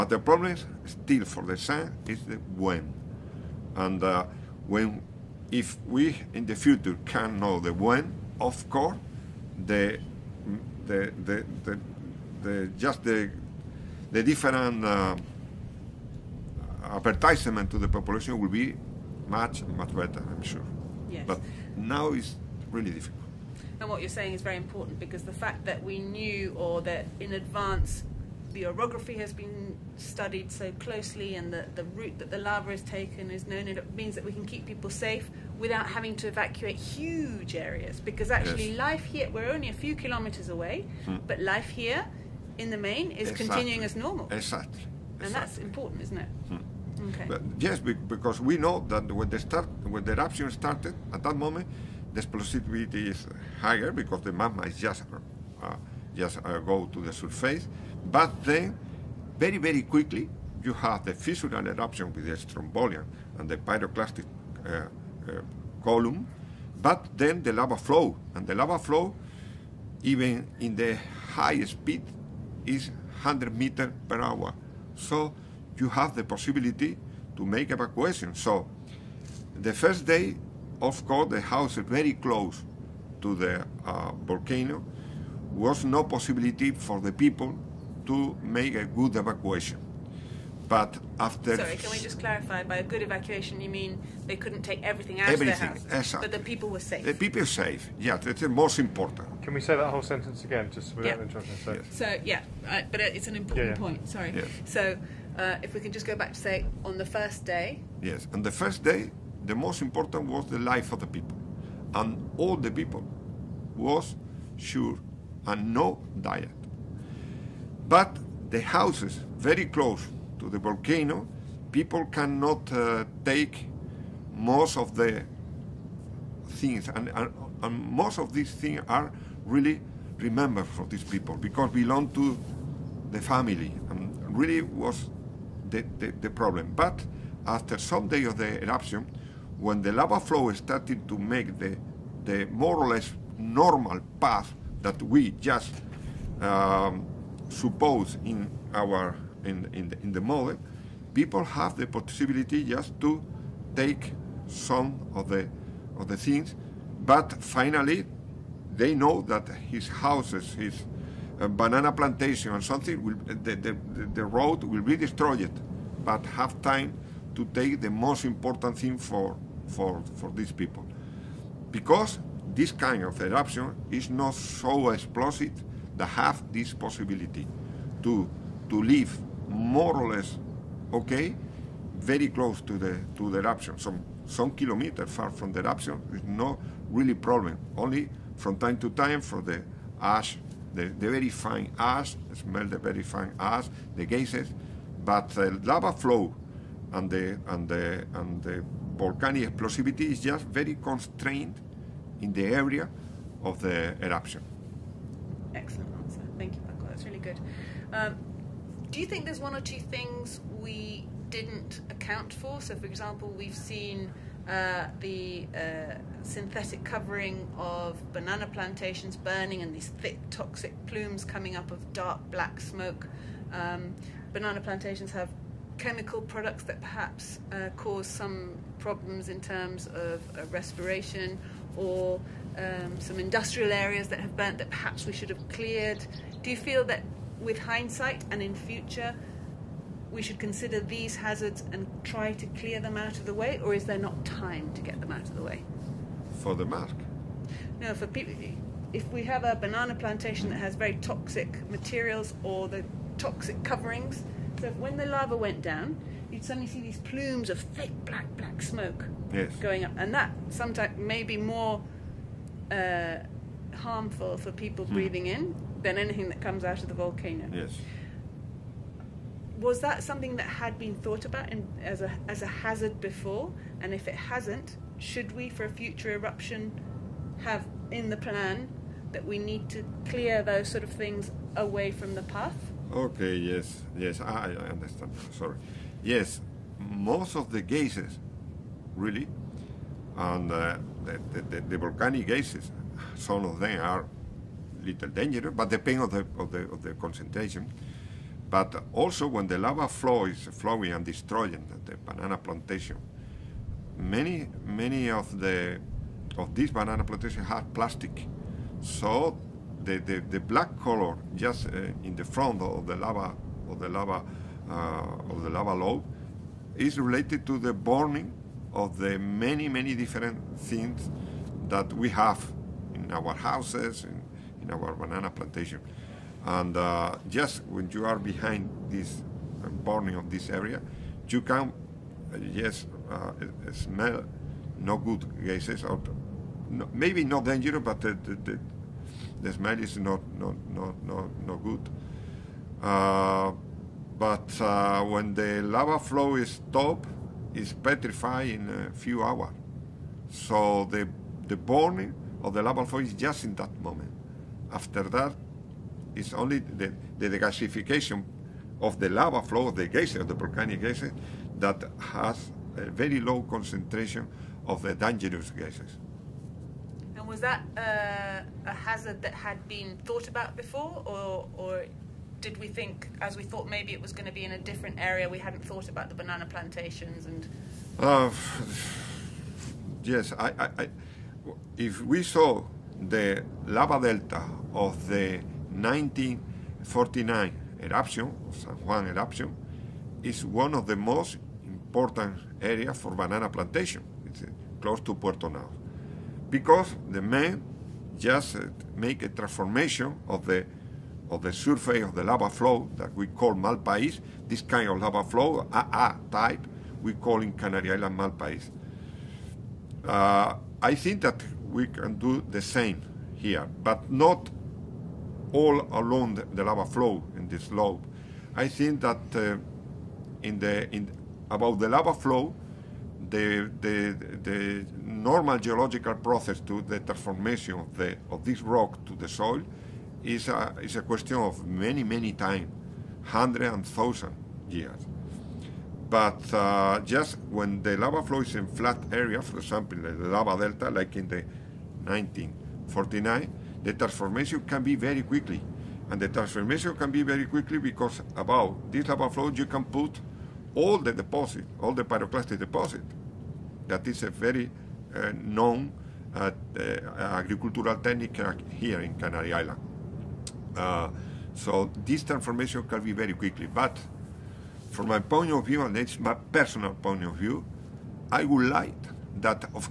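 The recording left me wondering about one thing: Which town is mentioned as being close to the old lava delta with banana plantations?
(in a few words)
Puerto Naos.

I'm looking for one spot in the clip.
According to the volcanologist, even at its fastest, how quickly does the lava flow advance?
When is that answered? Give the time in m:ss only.
1:13.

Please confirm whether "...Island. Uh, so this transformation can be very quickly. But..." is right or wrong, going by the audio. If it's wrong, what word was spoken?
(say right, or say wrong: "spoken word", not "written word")
right.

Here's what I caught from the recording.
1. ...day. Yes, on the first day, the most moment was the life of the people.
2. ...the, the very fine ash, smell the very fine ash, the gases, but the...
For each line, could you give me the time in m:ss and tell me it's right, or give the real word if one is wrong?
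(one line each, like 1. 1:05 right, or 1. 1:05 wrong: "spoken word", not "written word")
1. 1:47 wrong: "important", not "moment"
2. 3:10 right.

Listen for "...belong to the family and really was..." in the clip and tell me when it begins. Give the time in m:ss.
2:11.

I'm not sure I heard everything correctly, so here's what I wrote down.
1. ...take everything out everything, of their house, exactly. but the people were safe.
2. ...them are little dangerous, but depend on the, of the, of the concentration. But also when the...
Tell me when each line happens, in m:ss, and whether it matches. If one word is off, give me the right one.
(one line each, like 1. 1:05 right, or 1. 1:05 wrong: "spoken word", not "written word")
1. 1:34 right
2. 4:53 right.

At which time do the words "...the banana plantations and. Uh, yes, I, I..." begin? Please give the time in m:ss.
6:16.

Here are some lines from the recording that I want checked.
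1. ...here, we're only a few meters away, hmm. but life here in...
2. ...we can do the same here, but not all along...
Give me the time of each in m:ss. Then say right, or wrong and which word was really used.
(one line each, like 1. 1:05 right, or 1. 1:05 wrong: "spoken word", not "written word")
1. 0:39 wrong: "kilometers", not "meters"
2. 6:51 right.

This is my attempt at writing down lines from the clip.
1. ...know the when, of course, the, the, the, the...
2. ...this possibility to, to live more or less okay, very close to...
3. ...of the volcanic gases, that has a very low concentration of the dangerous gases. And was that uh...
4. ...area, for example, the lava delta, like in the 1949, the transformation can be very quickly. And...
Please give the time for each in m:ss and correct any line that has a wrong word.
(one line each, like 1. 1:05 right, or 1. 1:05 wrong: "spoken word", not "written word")
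1. 0:07 right
2. 2:56 right
3. 6:00 right
4. 7:19 right.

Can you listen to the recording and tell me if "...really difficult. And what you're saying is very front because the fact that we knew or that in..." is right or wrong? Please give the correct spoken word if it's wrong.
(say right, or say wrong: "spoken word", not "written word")
wrong: "important", not "front".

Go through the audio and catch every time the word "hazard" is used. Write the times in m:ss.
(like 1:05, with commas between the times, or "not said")
4:01, 4:32, 6:08.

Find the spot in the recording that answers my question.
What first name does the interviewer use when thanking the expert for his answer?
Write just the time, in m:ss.
3:26.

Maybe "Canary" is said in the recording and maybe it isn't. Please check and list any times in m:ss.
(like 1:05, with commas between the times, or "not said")
6:47, 7:39.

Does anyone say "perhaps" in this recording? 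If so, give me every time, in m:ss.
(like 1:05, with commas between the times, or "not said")
3:46, 3:54.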